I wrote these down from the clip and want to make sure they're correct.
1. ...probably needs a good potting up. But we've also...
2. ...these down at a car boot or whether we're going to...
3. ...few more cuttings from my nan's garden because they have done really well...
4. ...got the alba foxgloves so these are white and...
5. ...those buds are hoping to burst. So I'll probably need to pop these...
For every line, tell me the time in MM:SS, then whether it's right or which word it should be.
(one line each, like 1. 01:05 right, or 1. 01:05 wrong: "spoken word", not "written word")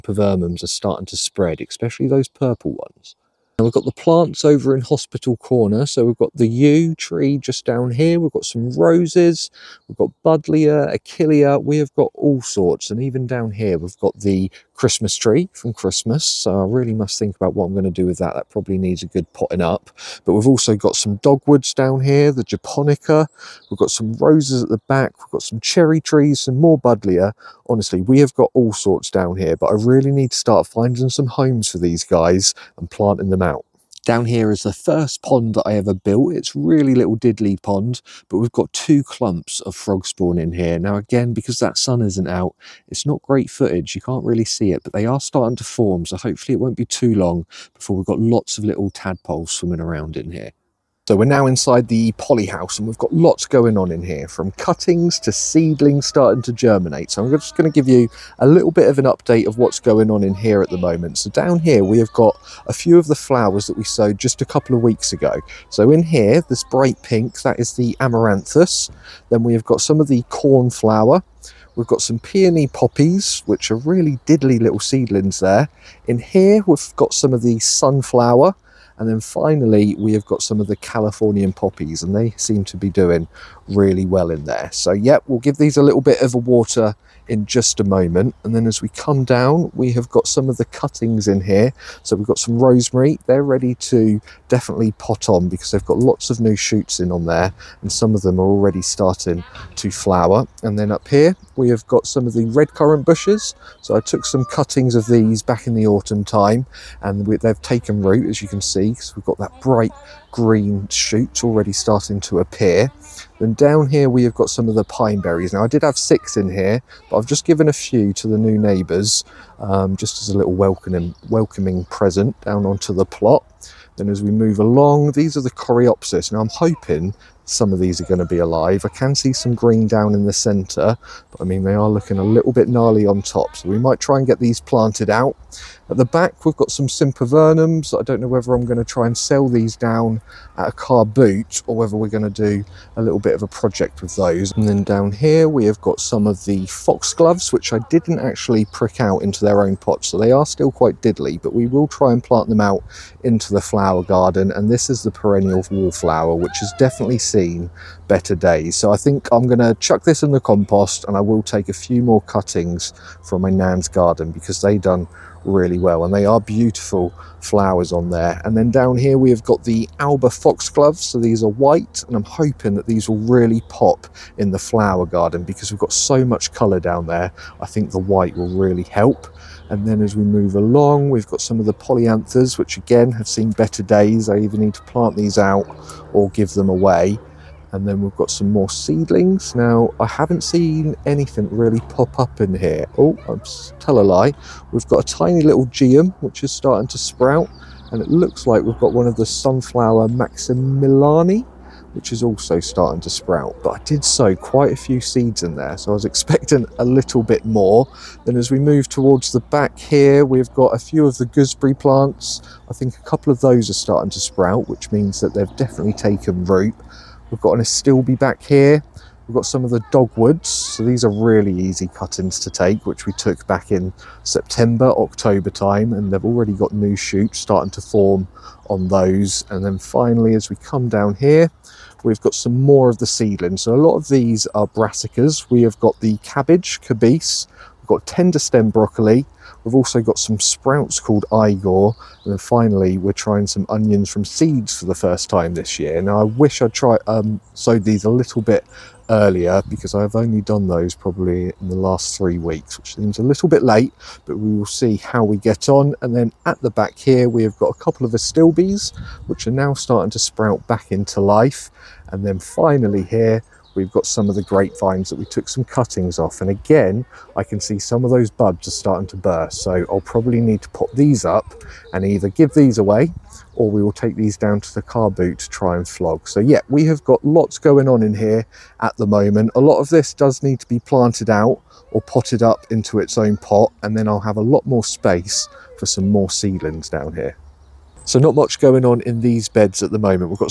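1. 00:18 right
2. 02:19 right
3. 02:41 right
4. 02:49 right
5. 04:28 wrong: "starting", not "hoping".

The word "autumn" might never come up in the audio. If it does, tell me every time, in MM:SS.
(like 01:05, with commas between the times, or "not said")
01:45.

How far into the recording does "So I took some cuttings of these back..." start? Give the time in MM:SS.
01:43.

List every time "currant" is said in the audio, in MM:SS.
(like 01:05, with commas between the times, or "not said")
01:42.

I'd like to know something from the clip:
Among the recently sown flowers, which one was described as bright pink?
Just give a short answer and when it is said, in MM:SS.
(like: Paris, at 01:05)
Amaranthus, at 01:07.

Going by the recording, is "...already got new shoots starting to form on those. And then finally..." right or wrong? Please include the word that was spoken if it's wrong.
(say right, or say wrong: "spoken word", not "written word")
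right.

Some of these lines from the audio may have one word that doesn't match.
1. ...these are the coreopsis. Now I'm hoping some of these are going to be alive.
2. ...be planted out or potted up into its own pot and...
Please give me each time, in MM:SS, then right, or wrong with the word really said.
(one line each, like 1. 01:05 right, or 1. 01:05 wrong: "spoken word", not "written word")
1. 02:05 right
2. 04:40 right.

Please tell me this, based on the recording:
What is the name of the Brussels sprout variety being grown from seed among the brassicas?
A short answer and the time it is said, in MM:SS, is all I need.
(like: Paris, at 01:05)
Igor, at 04:01.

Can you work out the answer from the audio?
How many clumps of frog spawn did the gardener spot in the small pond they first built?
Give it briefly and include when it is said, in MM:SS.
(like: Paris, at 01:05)
2, at 00:38.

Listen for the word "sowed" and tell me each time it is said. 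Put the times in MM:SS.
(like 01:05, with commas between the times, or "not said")
01:03, 04:07.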